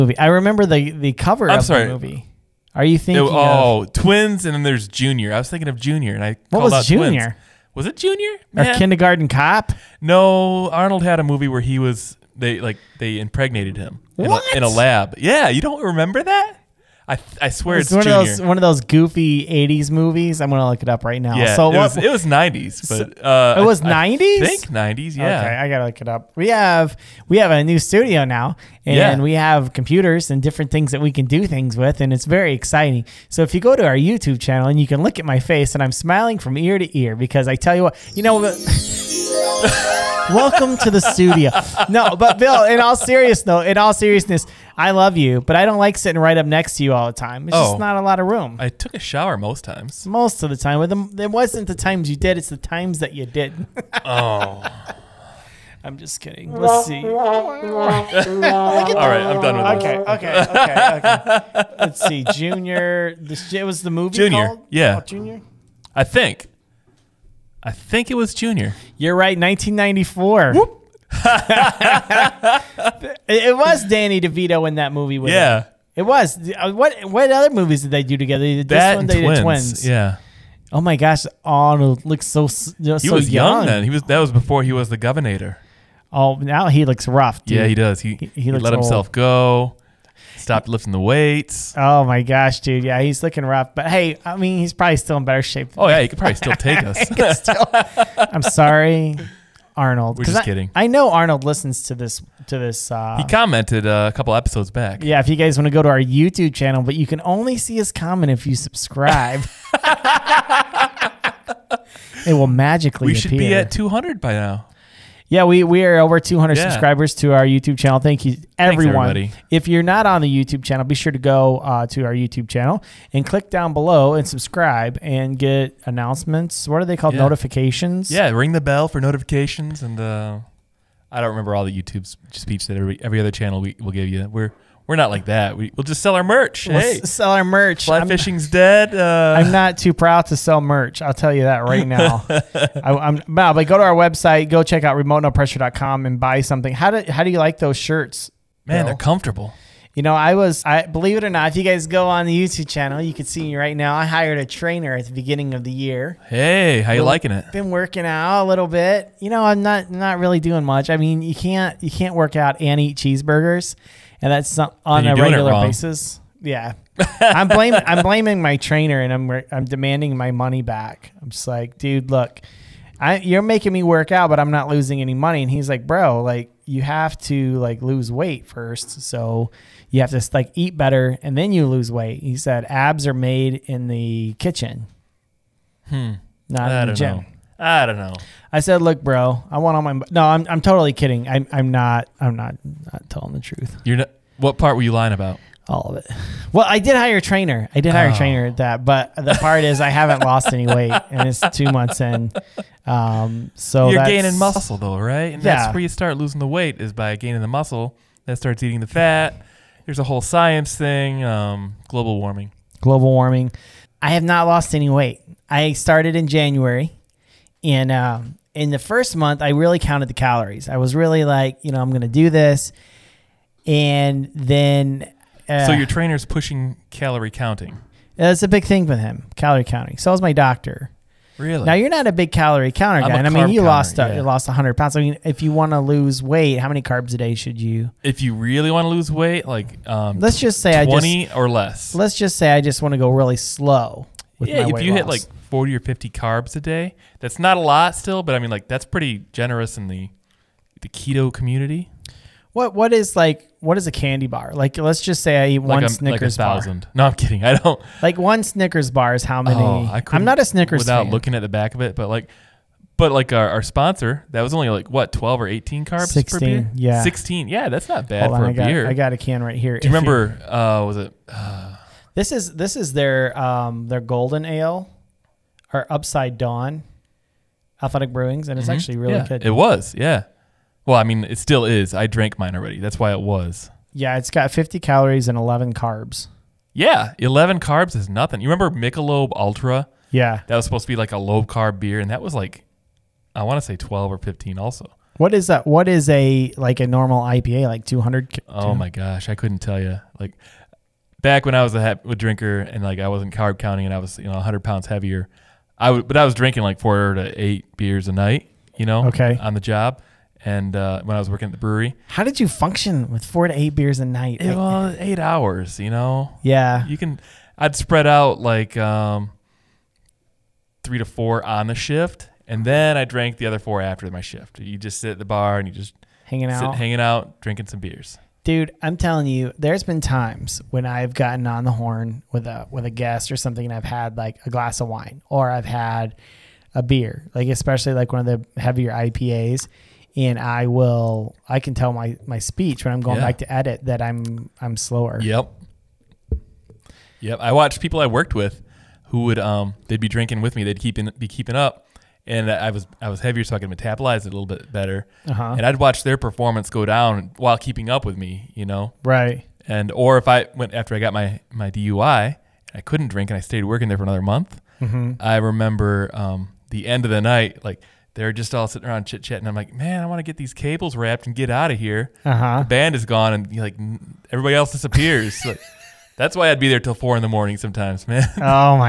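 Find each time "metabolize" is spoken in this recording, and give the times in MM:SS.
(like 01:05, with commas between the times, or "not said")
05:53.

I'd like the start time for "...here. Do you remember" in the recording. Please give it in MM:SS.
04:29.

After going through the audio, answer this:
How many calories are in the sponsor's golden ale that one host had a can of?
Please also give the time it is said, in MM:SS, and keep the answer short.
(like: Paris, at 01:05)
50, at 04:44.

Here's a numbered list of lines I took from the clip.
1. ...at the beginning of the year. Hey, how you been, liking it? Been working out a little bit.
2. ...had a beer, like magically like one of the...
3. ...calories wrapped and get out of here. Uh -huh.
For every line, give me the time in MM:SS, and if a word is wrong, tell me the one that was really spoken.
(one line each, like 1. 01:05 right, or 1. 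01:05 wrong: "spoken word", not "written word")
1. 02:34 right
2. 05:35 wrong: "especially", not "magically"
3. 06:10 wrong: "cables", not "calories".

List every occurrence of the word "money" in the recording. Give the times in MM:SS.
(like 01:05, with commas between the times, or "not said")
02:50, 02:55.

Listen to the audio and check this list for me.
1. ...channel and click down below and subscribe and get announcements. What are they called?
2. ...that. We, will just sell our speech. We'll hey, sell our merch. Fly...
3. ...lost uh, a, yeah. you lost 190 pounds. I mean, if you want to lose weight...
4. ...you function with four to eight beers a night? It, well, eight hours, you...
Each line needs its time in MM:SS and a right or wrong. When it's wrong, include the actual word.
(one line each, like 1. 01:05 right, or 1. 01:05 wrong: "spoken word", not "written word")
1. 02:02 right
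2. 02:15 wrong: "merch", not "speech"
3. 03:53 wrong: "100", not "190"
4. 05:12 right.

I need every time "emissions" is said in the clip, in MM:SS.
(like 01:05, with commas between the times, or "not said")
not said.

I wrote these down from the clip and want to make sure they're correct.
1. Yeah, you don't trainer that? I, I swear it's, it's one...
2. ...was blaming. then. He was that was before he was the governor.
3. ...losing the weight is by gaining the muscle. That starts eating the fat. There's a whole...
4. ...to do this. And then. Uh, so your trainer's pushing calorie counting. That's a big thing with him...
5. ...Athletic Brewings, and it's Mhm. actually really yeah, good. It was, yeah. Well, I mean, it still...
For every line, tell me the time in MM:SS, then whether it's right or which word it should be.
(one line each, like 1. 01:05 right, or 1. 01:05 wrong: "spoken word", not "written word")
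1. 00:15 wrong: "remember", not "trainer"
2. 01:23 wrong: "young", not "blaming"
3. 03:26 right
4. 03:42 right
5. 04:37 right.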